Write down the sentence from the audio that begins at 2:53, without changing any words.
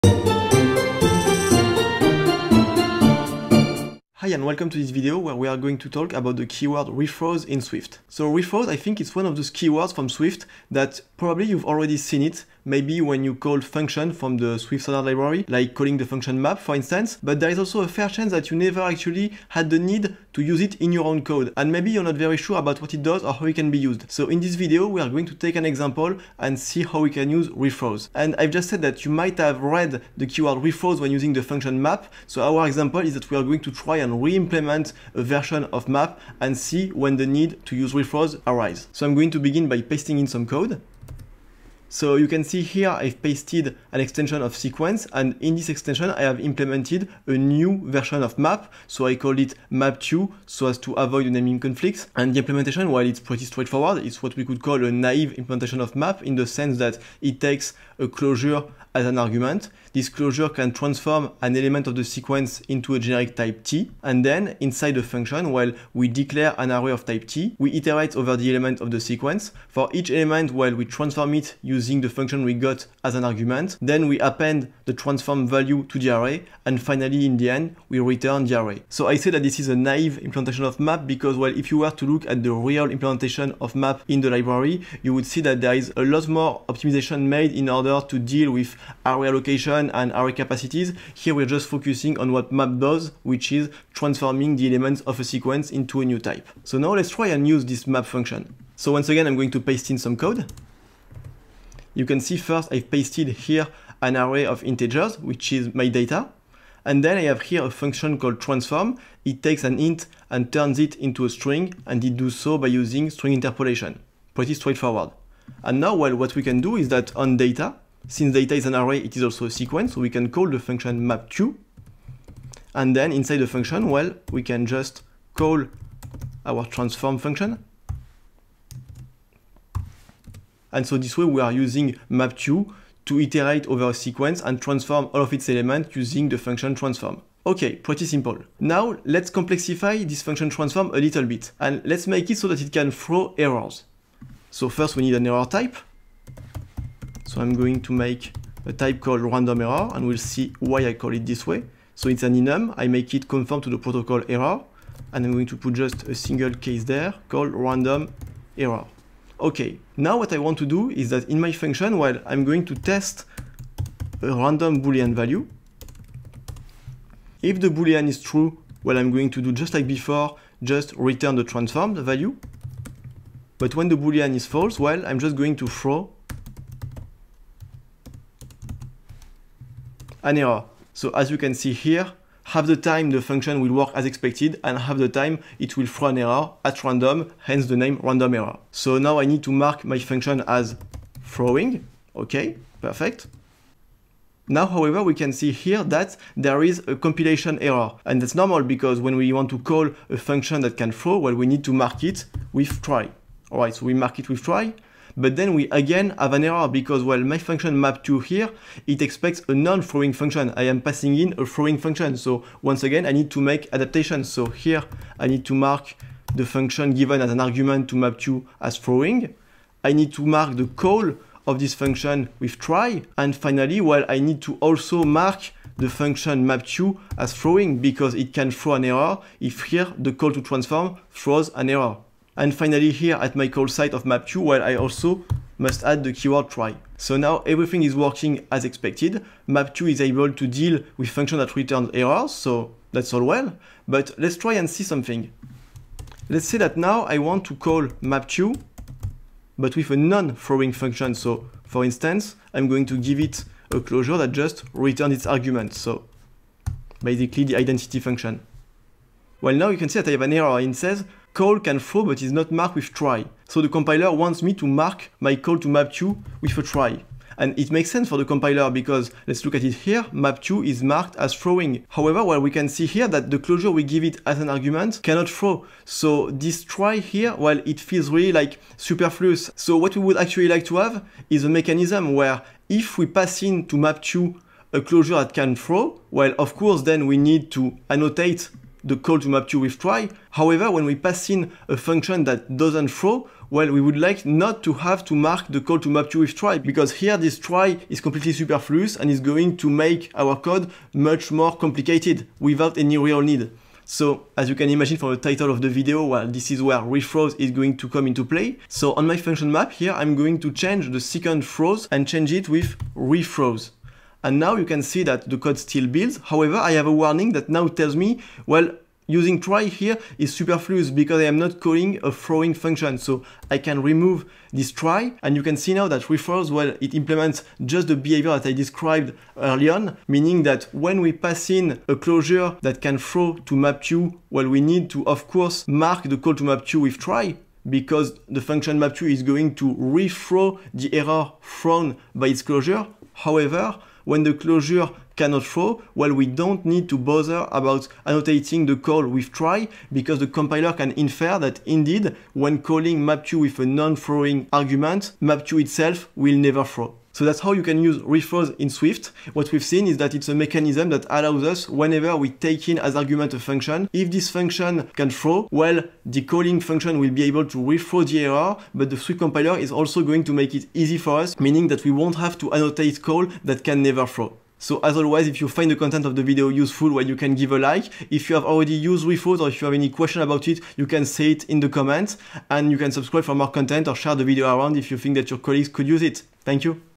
But when the boolean is false, well, I'm just going to throw an error.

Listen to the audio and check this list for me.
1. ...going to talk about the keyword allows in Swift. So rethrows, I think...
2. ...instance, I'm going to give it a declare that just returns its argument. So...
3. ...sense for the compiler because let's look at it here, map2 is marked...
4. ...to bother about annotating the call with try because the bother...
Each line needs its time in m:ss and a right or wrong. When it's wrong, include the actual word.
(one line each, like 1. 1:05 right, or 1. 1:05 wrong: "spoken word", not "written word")
1. 0:05 wrong: "rethrows", not "allows"
2. 4:11 wrong: "closure", not "declare"
3. 4:27 right
4. 5:46 wrong: "compiler", not "bother".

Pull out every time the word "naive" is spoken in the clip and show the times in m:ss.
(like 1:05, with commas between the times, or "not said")
0:54, 1:19.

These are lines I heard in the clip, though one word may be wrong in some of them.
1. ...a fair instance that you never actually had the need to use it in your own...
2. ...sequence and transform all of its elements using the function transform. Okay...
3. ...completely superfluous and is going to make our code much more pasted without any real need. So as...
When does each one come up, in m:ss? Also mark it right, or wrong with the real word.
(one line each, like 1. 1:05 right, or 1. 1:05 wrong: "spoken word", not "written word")
1. 0:17 wrong: "chance", not "instance"
2. 2:13 right
3. 4:58 wrong: "complicated", not "pasted".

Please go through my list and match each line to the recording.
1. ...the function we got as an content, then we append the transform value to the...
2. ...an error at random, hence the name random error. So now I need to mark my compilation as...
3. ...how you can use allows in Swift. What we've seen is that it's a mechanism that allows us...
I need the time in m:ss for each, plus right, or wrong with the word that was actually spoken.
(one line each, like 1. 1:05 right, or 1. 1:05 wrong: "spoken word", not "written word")
1. 1:11 wrong: "argument", not "content"
2. 3:06 wrong: "function", not "compilation"
3. 5:57 wrong: "rethrows", not "allows".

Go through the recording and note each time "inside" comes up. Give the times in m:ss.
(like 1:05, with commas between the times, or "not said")
1:04, 2:03.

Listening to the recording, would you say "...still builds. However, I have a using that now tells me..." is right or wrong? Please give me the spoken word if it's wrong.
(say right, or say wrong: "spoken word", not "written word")
wrong: "warning", not "using".